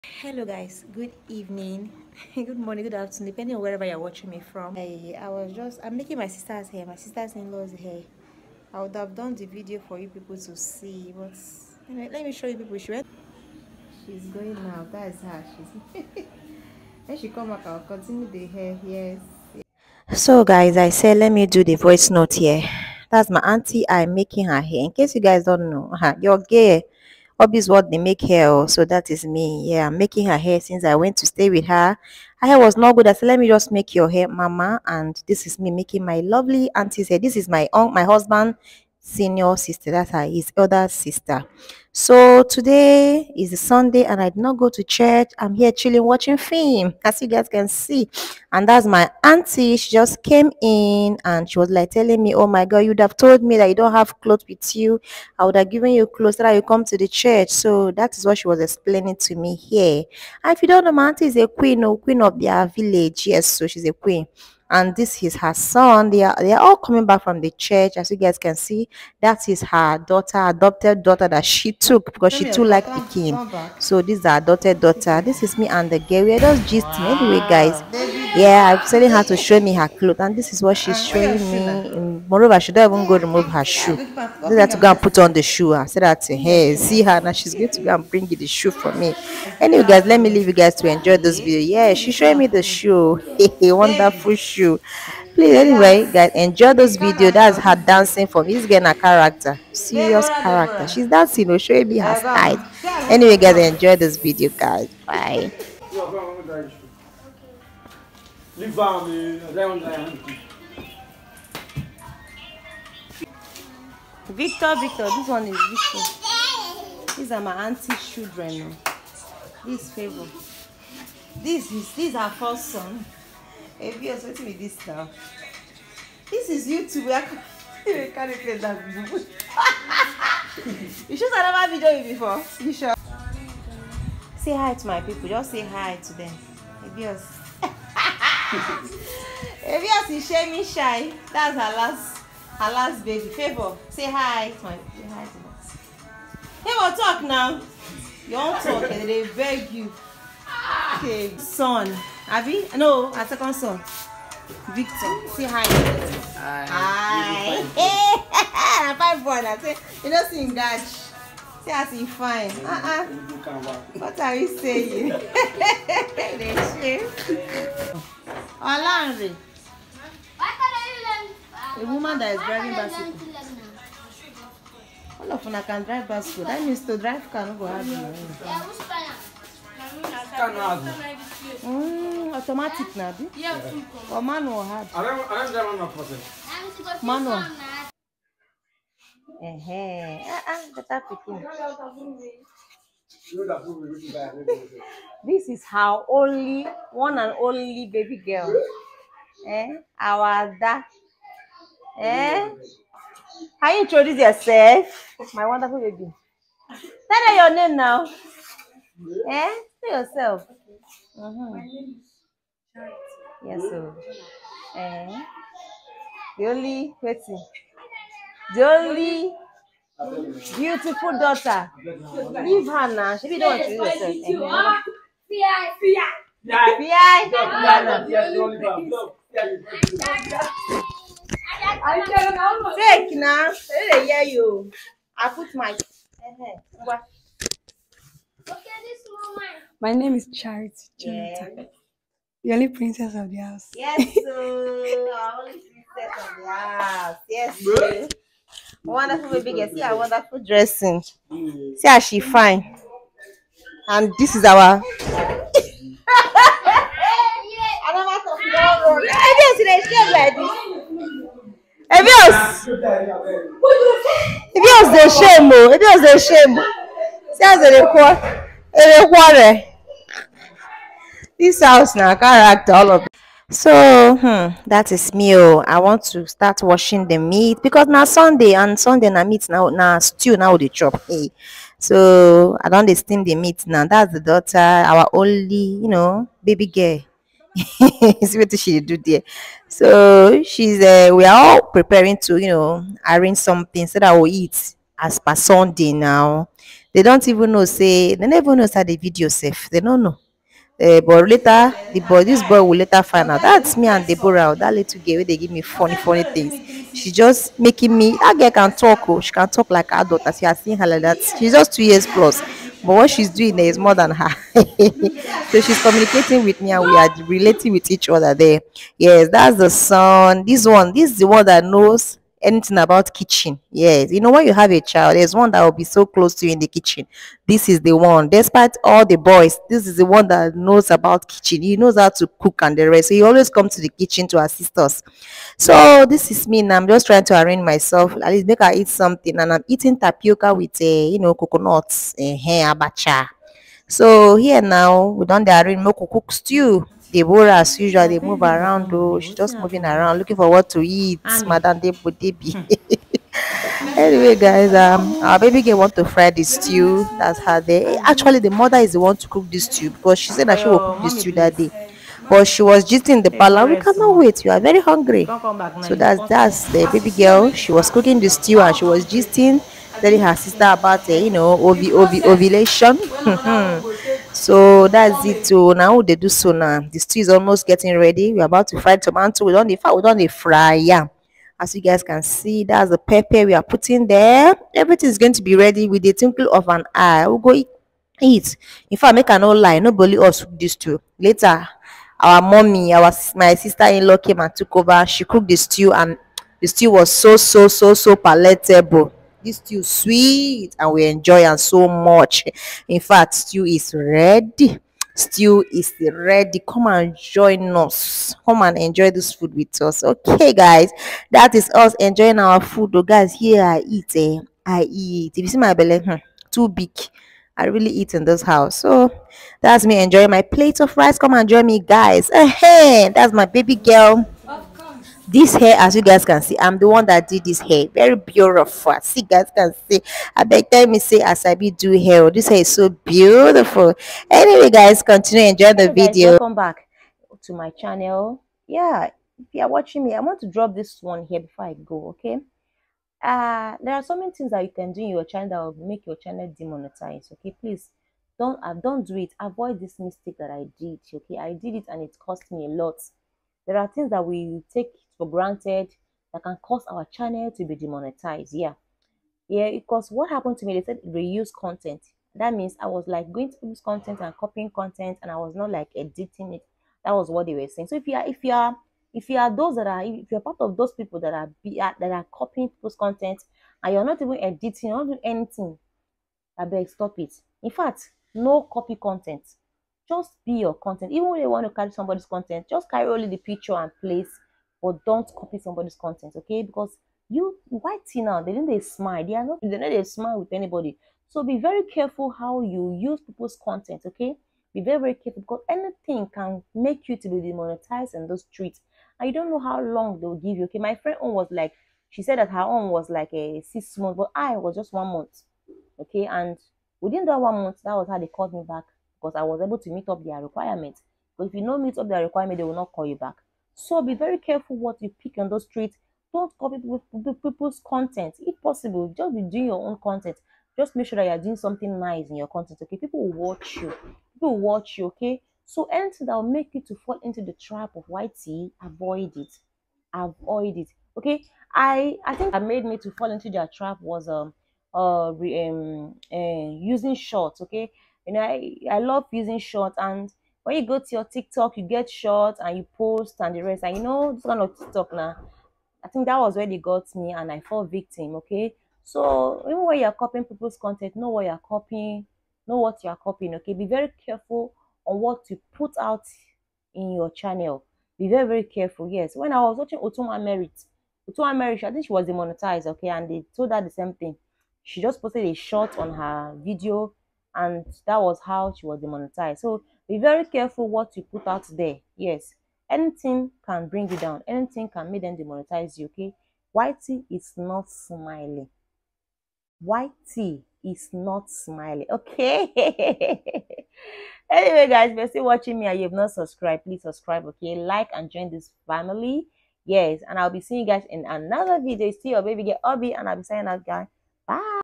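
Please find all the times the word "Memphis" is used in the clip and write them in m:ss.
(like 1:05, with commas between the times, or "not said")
not said.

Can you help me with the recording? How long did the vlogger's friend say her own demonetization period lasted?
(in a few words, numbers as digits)
6 months.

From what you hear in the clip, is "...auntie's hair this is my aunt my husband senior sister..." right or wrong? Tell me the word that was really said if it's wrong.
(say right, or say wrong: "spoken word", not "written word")
right.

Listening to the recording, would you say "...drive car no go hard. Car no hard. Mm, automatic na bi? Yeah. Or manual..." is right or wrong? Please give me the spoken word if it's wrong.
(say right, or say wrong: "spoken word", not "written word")
right.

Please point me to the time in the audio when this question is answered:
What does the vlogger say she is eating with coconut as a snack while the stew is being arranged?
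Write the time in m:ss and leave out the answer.
5:39.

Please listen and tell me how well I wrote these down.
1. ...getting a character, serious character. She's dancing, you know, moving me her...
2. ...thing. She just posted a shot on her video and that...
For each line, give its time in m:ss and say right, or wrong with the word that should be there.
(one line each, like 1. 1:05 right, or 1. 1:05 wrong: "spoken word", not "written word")
1. 1:38 wrong: "showing", not "moving"
2. 9:24 right.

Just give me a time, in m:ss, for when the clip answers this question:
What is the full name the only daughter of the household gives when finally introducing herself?
4:00.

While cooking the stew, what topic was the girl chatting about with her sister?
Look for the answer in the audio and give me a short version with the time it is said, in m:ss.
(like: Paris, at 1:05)
Ovulation, at 6:12.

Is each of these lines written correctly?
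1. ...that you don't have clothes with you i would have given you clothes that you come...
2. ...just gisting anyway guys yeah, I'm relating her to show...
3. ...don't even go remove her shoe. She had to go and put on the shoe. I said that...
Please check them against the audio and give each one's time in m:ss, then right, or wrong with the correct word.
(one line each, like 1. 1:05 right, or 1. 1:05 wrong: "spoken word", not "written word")
1. 0:53 right
2. 1:16 wrong: "telling", not "relating"
3. 1:22 right.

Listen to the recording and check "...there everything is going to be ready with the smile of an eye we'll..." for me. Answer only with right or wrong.
wrong.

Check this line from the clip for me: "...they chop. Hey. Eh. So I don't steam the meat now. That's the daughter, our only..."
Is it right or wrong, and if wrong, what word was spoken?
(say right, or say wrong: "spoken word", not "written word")
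right.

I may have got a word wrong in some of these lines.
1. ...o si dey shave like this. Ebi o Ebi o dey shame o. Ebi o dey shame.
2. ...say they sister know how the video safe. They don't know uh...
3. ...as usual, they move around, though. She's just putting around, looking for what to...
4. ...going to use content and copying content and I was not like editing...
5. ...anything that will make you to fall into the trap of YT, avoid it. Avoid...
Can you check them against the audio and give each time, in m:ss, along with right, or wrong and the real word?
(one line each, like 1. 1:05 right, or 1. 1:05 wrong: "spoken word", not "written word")
1. 4:19 right
2. 4:57 wrong: "never", not "sister"
3. 5:47 wrong: "moving", not "putting"
4. 7:43 right
5. 8:45 right.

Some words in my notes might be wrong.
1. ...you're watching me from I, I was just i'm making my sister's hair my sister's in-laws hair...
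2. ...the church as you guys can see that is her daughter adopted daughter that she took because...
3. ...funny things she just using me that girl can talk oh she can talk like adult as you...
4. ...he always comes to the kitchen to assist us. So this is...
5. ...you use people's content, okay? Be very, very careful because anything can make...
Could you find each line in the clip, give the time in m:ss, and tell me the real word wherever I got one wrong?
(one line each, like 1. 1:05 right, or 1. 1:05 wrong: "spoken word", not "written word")
1. 0:03 right
2. 1:07 right
3. 5:05 wrong: "making", not "using"
4. 5:33 right
5. 8:12 right.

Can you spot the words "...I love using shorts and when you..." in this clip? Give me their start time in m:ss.
8:58.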